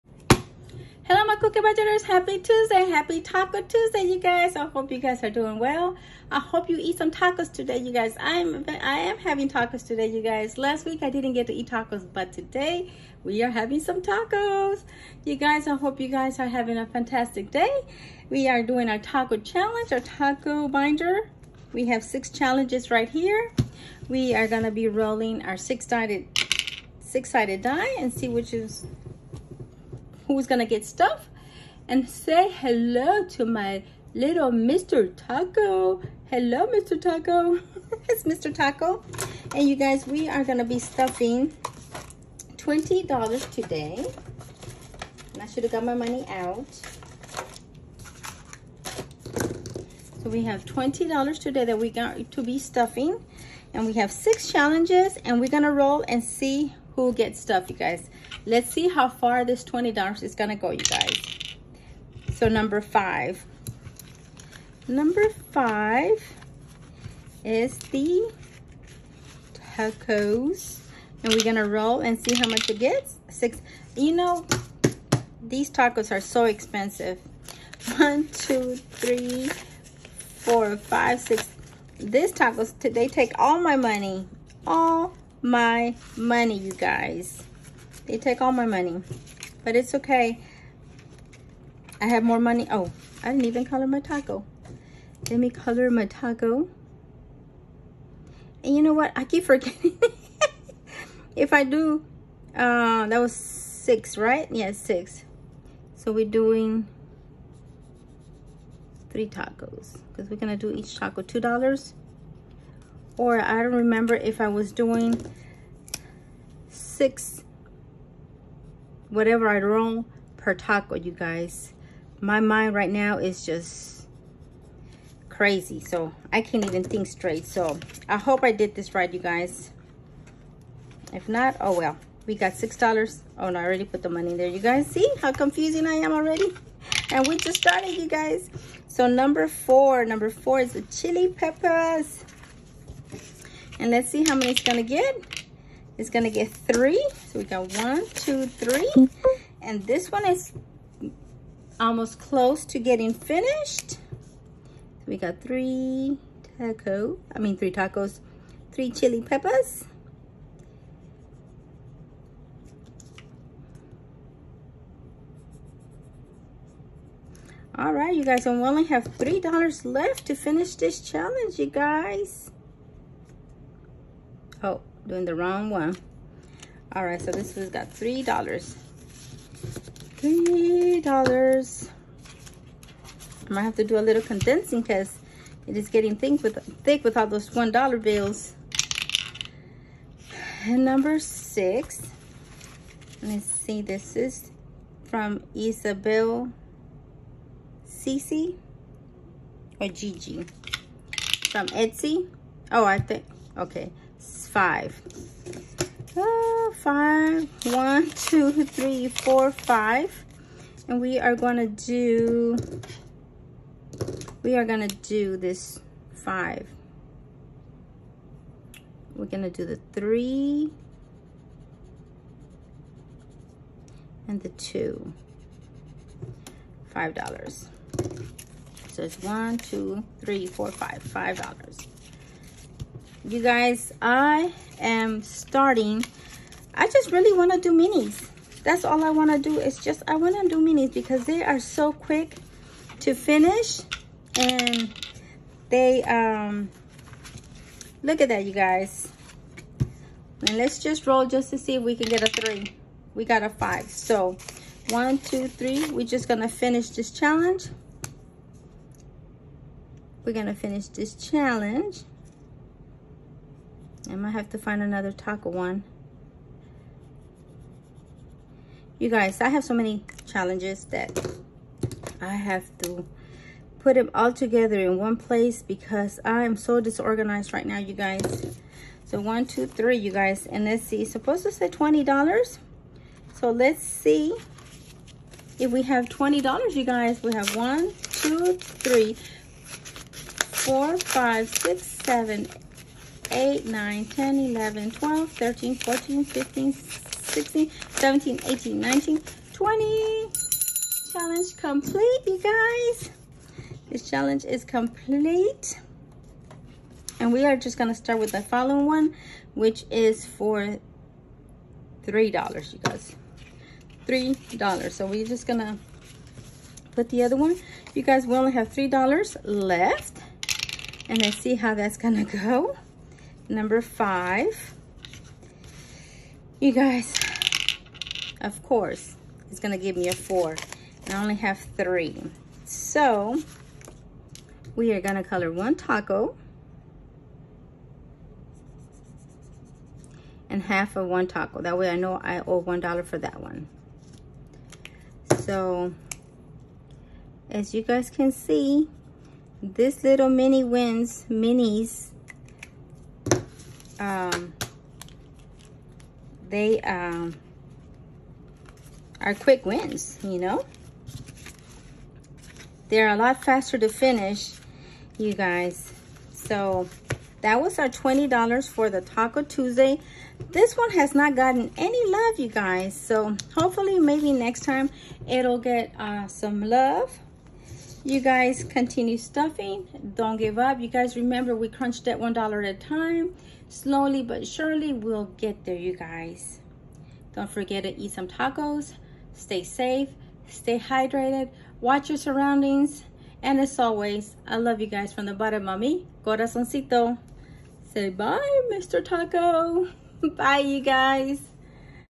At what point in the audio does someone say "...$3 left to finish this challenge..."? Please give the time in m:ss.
2:49.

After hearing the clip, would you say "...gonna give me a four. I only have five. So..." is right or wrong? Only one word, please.
wrong.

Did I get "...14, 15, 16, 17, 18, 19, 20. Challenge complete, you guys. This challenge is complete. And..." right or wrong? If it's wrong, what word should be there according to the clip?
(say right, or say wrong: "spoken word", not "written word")
right.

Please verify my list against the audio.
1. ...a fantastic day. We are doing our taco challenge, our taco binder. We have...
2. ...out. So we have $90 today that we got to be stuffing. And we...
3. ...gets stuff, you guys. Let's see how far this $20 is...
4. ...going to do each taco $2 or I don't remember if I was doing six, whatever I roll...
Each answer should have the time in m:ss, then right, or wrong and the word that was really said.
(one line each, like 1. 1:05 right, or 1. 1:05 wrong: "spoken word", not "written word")
1. 0:16 right
2. 0:46 wrong: "20", not "90"
3. 0:57 right
4. 1:50 right.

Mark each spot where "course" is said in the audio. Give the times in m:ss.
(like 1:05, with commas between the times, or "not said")
5:28.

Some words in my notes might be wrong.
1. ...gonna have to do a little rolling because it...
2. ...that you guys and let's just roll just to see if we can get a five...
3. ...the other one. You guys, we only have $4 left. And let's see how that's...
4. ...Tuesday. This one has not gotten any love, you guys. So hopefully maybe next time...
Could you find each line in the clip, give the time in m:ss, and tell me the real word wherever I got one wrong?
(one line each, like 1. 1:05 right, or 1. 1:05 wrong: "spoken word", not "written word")
1. 3:03 wrong: "condensing", not "rolling"
2. 4:08 wrong: "three", not "five"
3. 5:17 wrong: "3", not "4"
4. 6:09 right.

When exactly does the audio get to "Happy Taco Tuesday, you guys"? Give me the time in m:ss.
0:02.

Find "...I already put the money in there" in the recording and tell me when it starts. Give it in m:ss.
2:13.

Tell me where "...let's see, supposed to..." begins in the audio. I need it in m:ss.
4:40.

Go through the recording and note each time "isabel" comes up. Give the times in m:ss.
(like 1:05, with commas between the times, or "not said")
3:15.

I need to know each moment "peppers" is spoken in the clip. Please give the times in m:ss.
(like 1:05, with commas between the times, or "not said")
2:21, 2:39.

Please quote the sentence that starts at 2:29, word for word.
And this one is almost close to getting finished.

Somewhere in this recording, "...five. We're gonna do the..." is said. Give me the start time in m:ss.
3:36.